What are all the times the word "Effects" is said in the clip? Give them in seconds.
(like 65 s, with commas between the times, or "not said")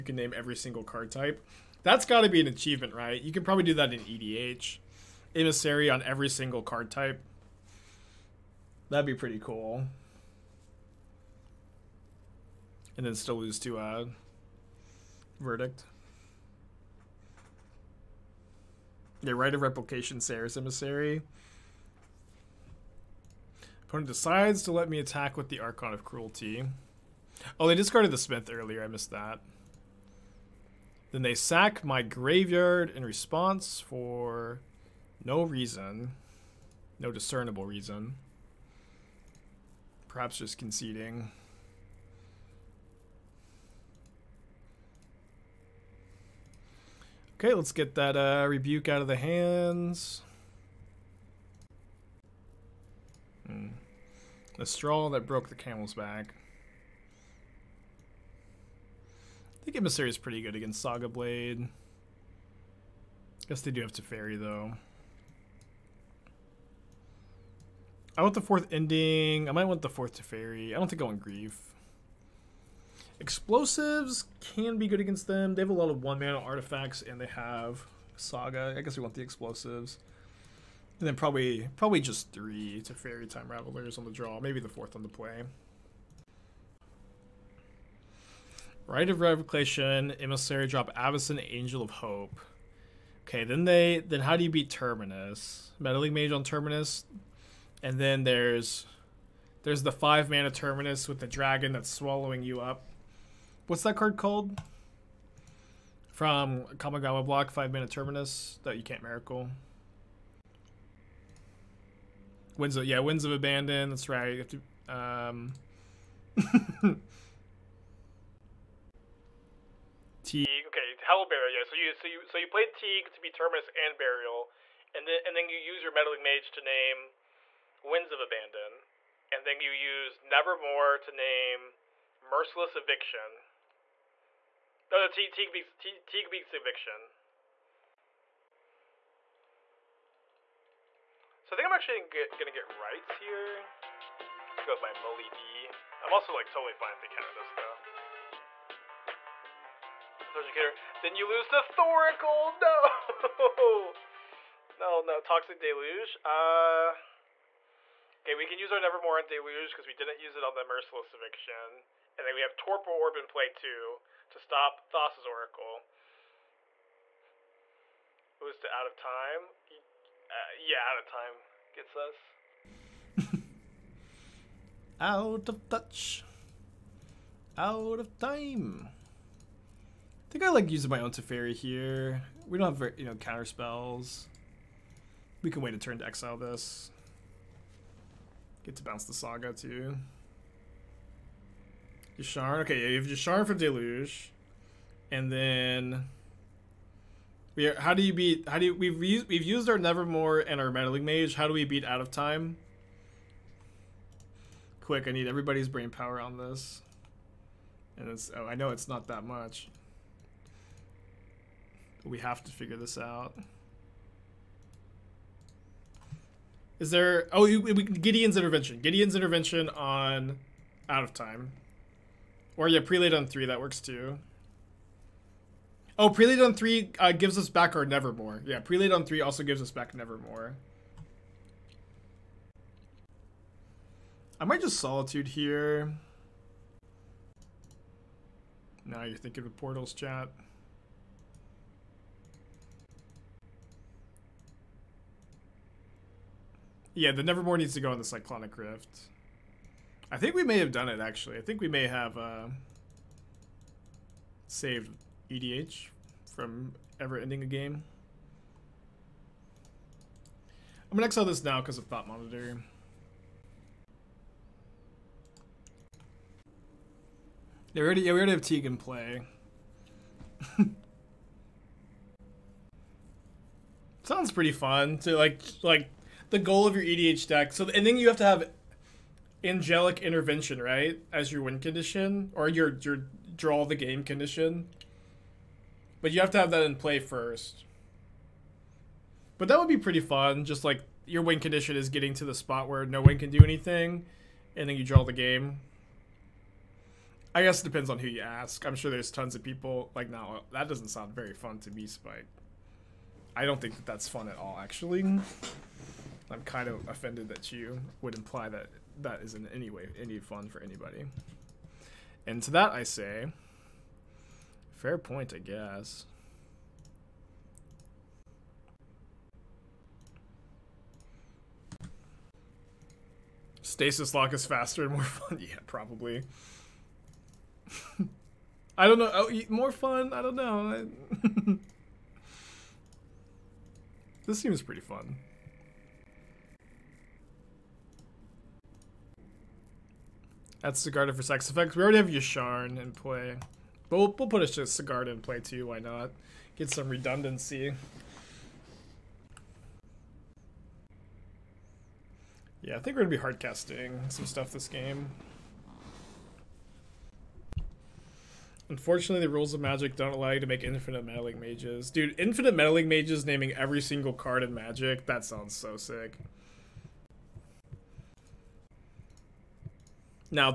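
341 s.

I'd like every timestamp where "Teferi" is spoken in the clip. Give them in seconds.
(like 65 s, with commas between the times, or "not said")
63 s, 70 s, 82 s, 181 s.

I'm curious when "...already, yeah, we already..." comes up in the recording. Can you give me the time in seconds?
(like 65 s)
267 s.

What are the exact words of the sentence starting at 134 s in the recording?
No, no, Teague, beats, Teague, beats Eviction.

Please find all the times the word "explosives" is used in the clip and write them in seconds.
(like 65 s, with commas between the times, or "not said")
73 s, 79 s.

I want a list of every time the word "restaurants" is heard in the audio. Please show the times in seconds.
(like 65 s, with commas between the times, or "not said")
not said.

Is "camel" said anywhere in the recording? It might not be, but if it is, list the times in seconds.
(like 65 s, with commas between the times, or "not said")
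55 s.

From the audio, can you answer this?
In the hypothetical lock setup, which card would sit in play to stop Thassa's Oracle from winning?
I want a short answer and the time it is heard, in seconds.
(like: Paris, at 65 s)
Torpor Orb, at 162 s.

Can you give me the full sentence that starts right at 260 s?
I'm gonna exile this now because of Thought Monitor.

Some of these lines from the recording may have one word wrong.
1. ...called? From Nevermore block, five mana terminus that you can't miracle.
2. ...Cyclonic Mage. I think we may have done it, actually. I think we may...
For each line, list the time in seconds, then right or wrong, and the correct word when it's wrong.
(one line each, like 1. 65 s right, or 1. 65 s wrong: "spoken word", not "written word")
1. 104 s wrong: "Kamigawa", not "Nevermore"
2. 248 s wrong: "Rift", not "Mage".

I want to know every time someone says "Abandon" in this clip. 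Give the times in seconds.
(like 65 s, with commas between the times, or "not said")
113 s, 128 s.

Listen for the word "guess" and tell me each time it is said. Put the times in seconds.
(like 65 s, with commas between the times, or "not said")
63 s, 78 s, 297 s, 315 s.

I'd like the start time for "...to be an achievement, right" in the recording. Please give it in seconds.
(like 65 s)
2 s.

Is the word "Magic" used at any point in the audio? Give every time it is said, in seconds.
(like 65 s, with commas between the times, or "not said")
359 s, 364 s.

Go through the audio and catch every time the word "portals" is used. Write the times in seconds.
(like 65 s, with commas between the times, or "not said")
239 s.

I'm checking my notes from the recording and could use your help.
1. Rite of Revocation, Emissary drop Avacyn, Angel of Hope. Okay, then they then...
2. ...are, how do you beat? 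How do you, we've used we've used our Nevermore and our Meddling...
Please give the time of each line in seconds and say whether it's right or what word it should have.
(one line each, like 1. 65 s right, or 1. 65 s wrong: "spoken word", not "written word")
1. 88 s right
2. 197 s right.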